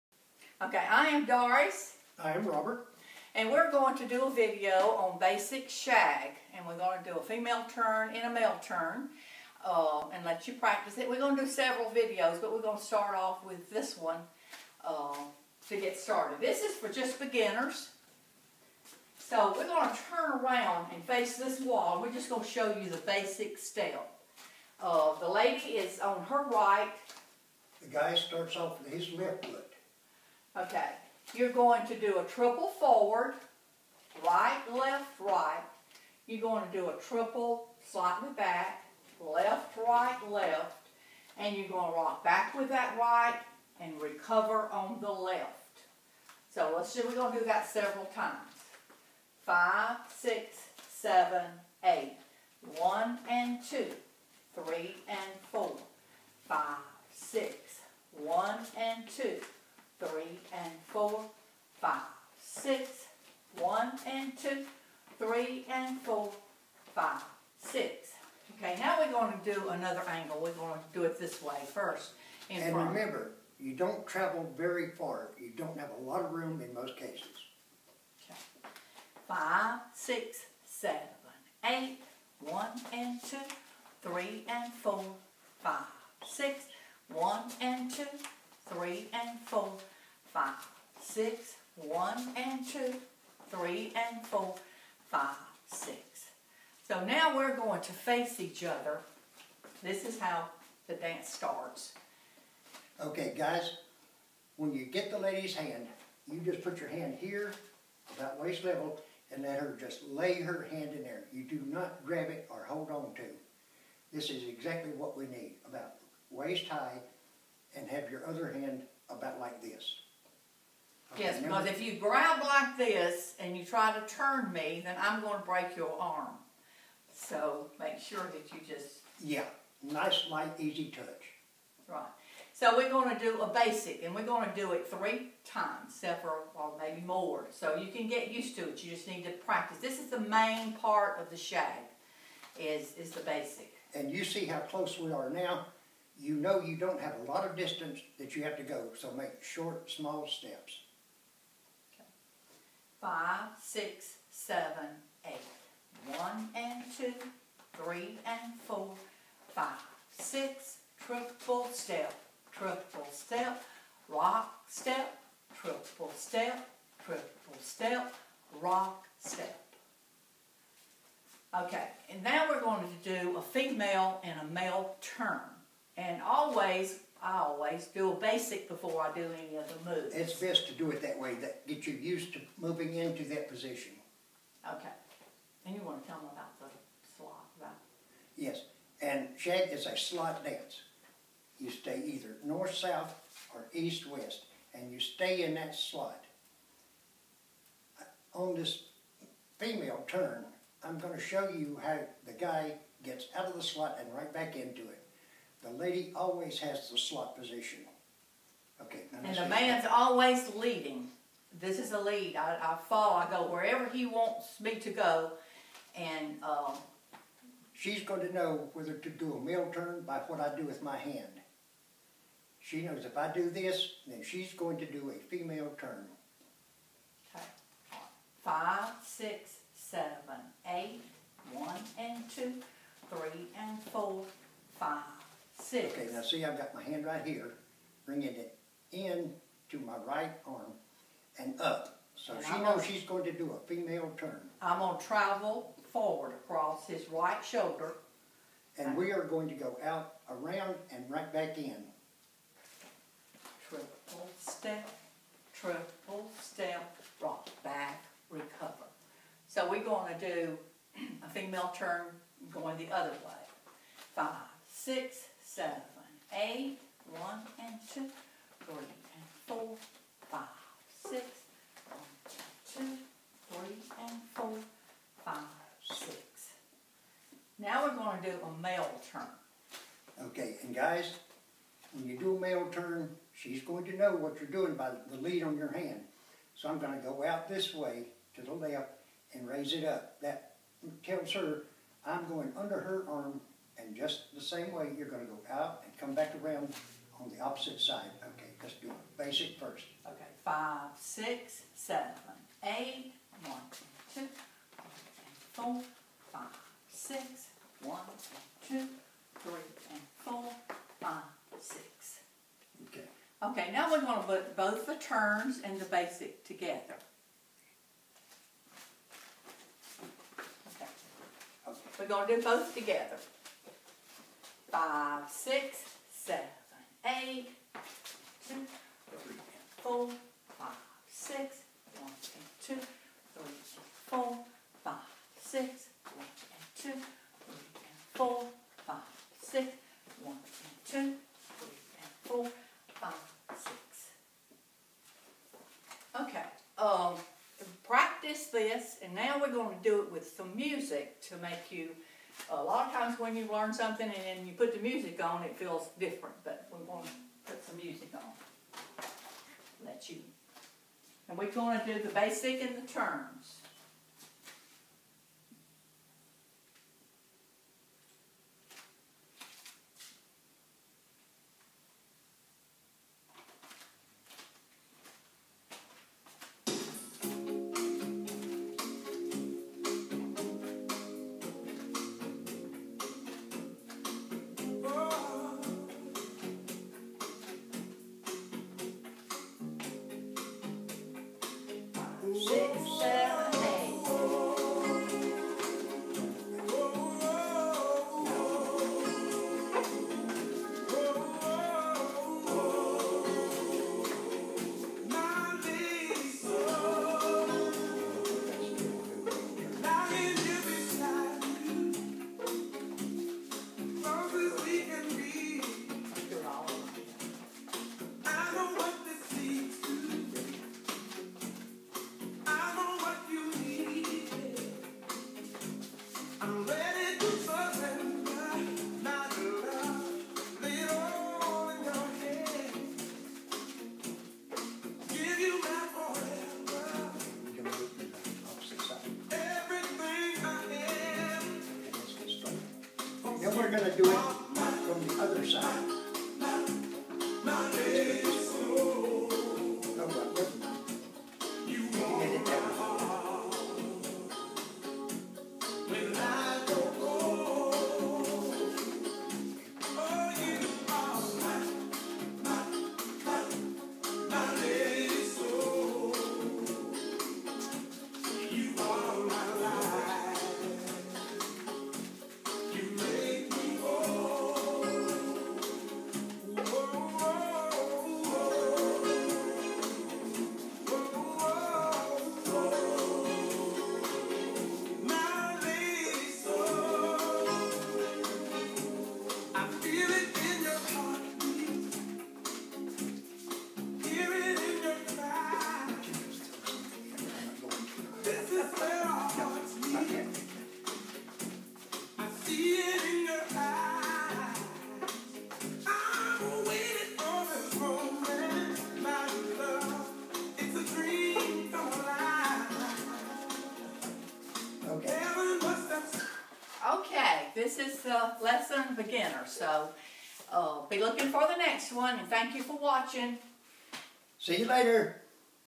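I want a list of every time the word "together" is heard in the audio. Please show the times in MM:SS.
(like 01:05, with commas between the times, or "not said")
05:16, 05:22.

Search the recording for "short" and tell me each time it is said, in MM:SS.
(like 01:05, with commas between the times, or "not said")
02:29.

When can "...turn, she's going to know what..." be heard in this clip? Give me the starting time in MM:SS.
04:42.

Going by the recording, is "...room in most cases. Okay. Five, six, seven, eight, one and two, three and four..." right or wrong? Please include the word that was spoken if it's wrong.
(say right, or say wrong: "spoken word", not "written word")
right.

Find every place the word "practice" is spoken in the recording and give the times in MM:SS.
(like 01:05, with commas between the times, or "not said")
00:10, 02:19, 05:47.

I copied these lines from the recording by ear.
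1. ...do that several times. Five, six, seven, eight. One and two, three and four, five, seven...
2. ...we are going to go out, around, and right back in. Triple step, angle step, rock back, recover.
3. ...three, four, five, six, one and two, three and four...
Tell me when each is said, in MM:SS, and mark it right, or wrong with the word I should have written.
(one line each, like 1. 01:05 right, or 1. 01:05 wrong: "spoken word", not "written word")
1. 00:47 wrong: "six", not "seven"
2. 04:08 wrong: "triple", not "angle"
3. 05:29 right.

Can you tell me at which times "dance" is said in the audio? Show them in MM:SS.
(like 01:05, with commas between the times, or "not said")
01:40, 03:10.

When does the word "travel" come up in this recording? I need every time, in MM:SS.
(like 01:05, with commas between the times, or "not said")
01:14, 04:05.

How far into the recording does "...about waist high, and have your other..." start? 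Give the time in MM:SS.
01:55.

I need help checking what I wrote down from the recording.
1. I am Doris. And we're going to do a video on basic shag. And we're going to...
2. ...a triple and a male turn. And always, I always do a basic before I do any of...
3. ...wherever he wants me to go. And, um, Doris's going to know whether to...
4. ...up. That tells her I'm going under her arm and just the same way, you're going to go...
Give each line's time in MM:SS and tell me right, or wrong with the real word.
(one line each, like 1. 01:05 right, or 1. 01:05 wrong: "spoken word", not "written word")
1. 00:02 wrong: "Robert", not "Doris"
2. 02:53 wrong: "female", not "triple"
3. 03:33 wrong: "She", not "Doris"
4. 04:49 right.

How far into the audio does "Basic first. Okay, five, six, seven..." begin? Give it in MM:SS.
04:59.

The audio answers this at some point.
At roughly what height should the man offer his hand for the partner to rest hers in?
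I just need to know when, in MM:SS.
01:48.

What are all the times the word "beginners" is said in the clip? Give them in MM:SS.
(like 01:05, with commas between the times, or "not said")
00:17, 08:38.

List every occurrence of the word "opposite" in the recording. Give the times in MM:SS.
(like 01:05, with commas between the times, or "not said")
04:57.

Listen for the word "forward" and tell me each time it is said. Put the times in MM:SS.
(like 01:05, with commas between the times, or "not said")
00:32, 04:05.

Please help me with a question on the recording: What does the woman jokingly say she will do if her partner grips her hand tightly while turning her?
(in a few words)
Break your arm.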